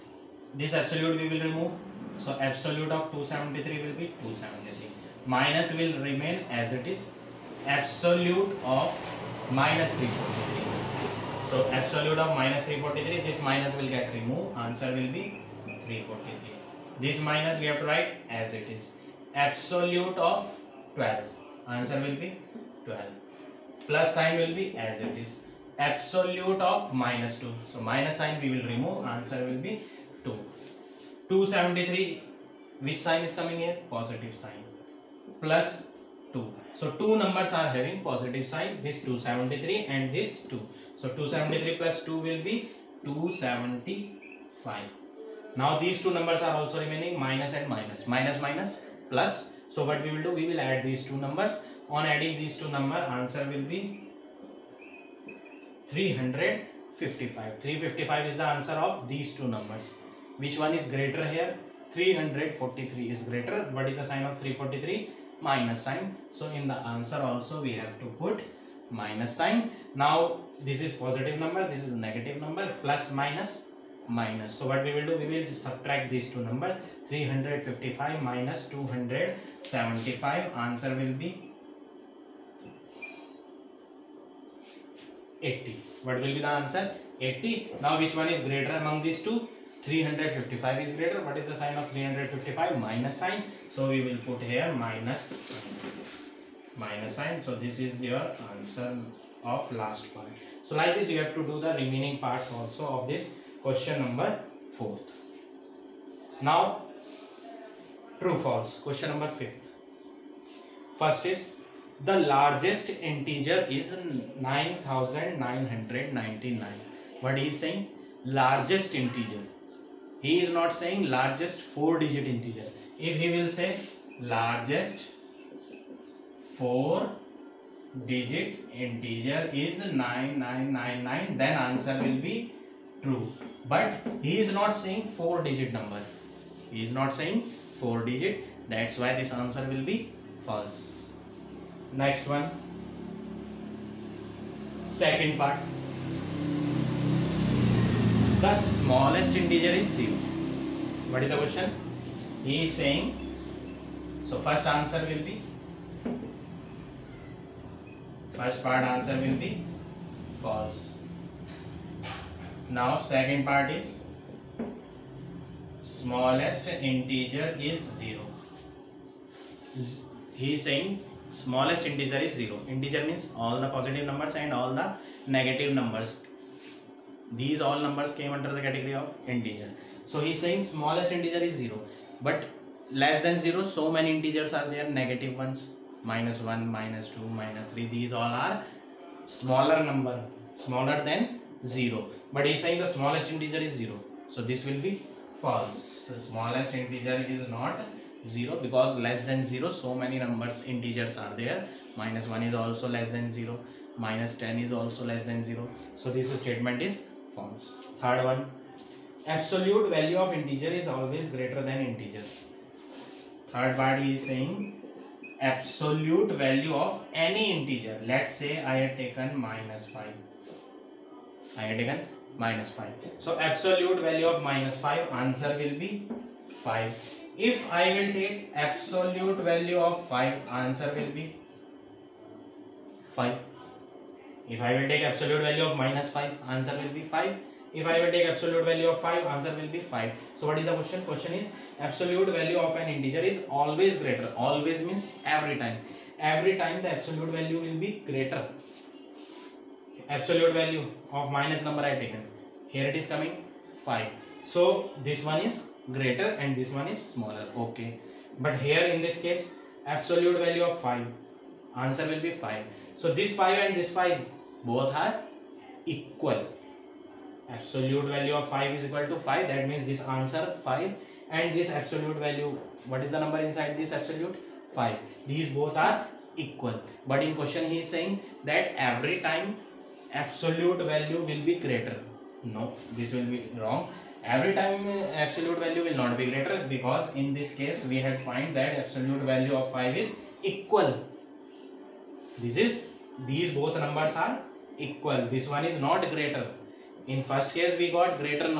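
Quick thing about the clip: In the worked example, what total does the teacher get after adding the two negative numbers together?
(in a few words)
355.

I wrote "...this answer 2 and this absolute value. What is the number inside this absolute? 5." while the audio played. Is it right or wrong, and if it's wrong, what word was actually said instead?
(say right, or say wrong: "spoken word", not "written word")
wrong: "5", not "2".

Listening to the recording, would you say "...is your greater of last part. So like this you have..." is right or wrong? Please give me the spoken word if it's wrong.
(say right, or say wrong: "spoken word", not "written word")
wrong: "answer", not "greater".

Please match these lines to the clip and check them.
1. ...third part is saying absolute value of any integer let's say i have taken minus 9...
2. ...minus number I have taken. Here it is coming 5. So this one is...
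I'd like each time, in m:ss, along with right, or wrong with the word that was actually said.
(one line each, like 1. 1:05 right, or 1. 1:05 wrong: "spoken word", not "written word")
1. 3:33 wrong: "5", not "9"
2. 4:11 right.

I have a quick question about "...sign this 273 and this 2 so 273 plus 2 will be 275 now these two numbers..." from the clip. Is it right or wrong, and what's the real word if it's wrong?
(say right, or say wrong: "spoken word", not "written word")
right.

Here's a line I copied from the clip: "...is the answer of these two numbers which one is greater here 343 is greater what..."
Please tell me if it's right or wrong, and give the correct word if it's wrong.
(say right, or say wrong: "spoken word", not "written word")
right.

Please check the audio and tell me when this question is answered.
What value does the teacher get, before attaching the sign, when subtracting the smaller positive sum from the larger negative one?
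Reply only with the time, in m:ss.
1:20.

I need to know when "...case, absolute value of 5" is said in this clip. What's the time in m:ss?
4:19.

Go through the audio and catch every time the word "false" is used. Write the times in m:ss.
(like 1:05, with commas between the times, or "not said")
2:20, 2:40, 3:15, 3:27.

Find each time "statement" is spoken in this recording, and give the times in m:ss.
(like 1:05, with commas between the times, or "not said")
3:26.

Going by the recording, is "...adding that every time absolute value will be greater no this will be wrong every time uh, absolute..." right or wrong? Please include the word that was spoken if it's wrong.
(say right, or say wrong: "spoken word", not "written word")
wrong: "saying", not "adding".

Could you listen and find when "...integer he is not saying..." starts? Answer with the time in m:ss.
1:58.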